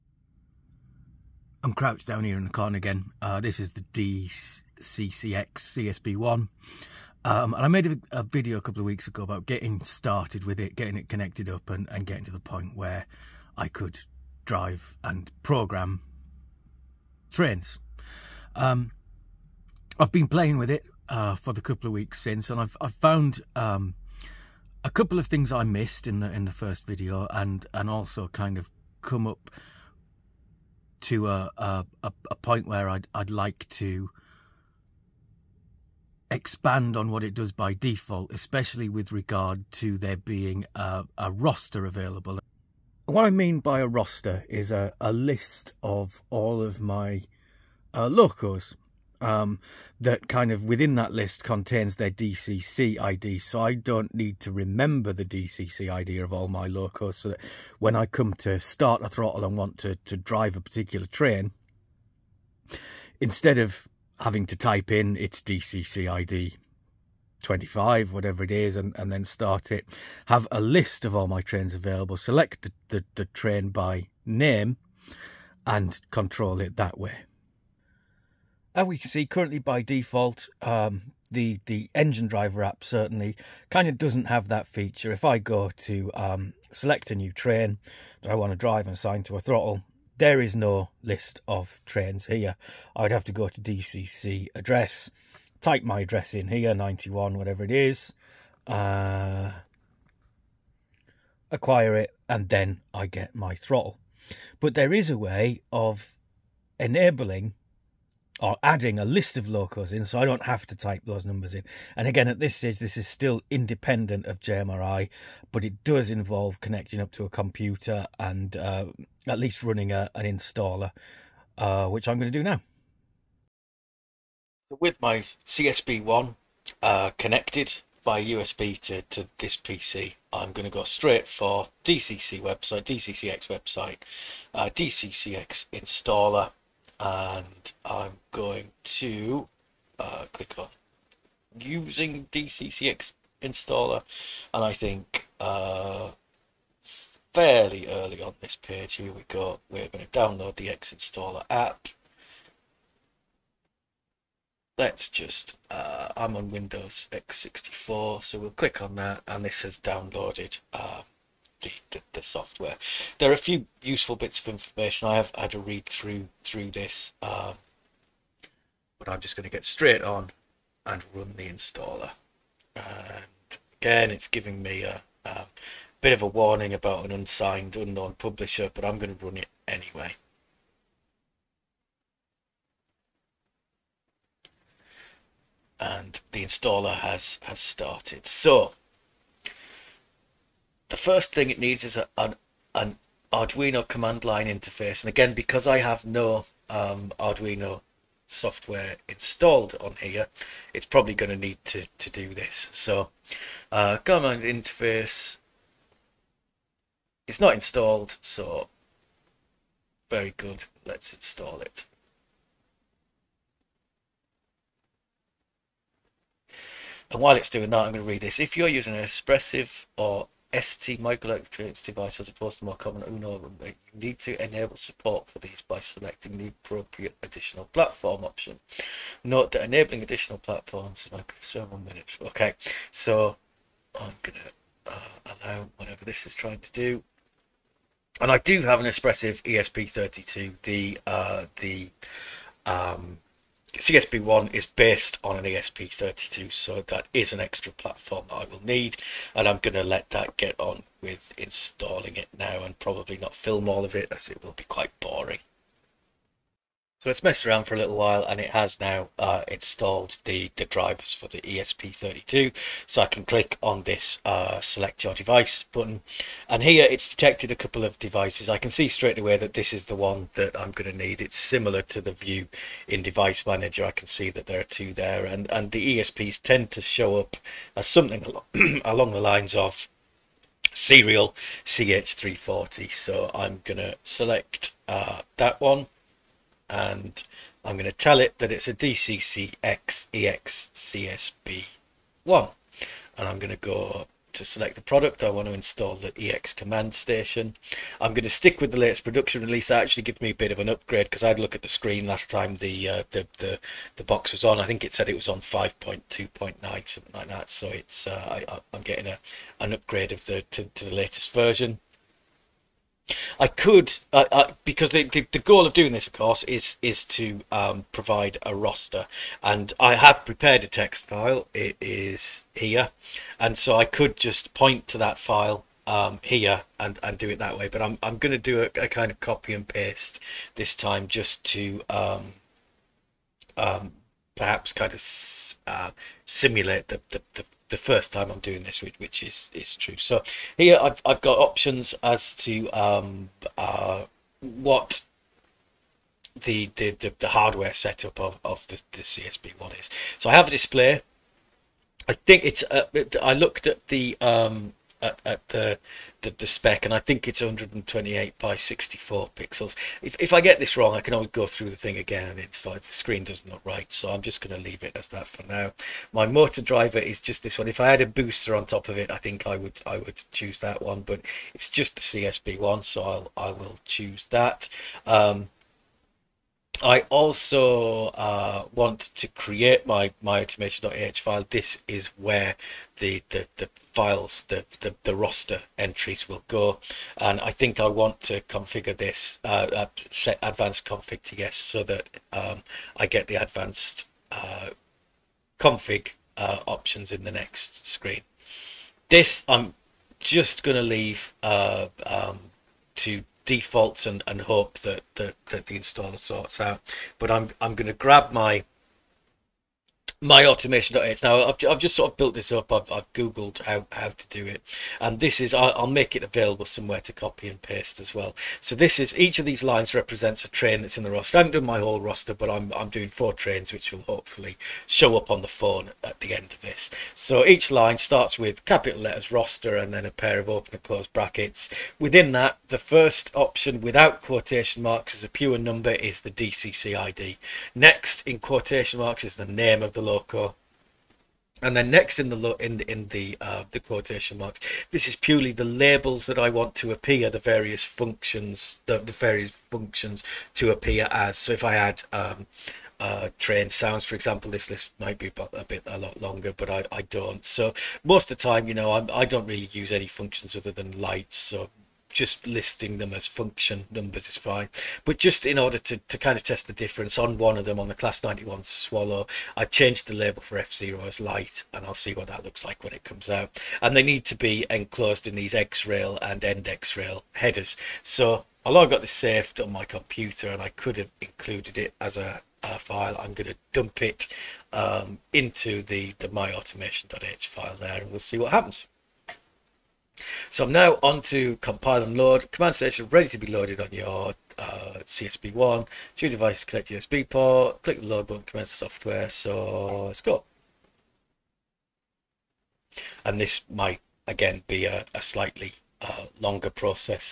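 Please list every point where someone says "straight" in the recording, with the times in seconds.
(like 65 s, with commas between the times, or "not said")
130 s, 169 s, 268 s.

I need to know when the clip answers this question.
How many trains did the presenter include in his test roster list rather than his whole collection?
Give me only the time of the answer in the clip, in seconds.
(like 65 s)
423 s.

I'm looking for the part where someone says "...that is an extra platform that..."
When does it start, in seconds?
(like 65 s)
246 s.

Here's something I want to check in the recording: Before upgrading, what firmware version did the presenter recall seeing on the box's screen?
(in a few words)
5.2.9.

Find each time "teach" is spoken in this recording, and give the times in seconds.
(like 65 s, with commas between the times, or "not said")
not said.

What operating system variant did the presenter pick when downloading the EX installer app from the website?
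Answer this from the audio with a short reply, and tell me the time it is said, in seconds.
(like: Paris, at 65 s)
Windows X64, at 156 s.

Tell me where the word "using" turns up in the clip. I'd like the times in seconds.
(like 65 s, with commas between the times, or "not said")
141 s, 218 s.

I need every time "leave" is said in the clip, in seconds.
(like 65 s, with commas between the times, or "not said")
364 s, 400 s.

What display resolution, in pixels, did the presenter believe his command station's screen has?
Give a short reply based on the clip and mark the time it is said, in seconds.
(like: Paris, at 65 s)
128 by 64, at 357 s.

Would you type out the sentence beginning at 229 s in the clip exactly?
Note that enabling additional platforms like several minutes.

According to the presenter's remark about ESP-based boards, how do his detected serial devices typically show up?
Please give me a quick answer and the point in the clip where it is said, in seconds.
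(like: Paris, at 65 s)
serial CH340, at 280 s.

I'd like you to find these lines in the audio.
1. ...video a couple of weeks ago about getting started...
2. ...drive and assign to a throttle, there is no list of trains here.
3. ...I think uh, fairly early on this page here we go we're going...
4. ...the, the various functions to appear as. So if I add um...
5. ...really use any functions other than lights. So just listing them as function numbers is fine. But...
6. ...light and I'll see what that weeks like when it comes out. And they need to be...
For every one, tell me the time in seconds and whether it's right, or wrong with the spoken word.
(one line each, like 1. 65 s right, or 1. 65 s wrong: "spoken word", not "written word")
1. 8 s right
2. 88 s right
3. 144 s right
4. 448 s right
5. 459 s right
6. 471 s wrong: "looks", not "weeks".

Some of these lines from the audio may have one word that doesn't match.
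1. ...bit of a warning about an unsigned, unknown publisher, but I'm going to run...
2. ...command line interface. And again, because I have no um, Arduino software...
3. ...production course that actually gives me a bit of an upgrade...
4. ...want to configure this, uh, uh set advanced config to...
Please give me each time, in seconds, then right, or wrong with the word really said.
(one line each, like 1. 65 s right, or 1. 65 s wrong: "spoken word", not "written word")
1. 176 s right
2. 193 s right
3. 299 s wrong: "release", not "course"
4. 387 s right.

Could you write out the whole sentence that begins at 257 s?
So it's messed around for a little while and it has now uh, installed the, the drivers for the ESP32.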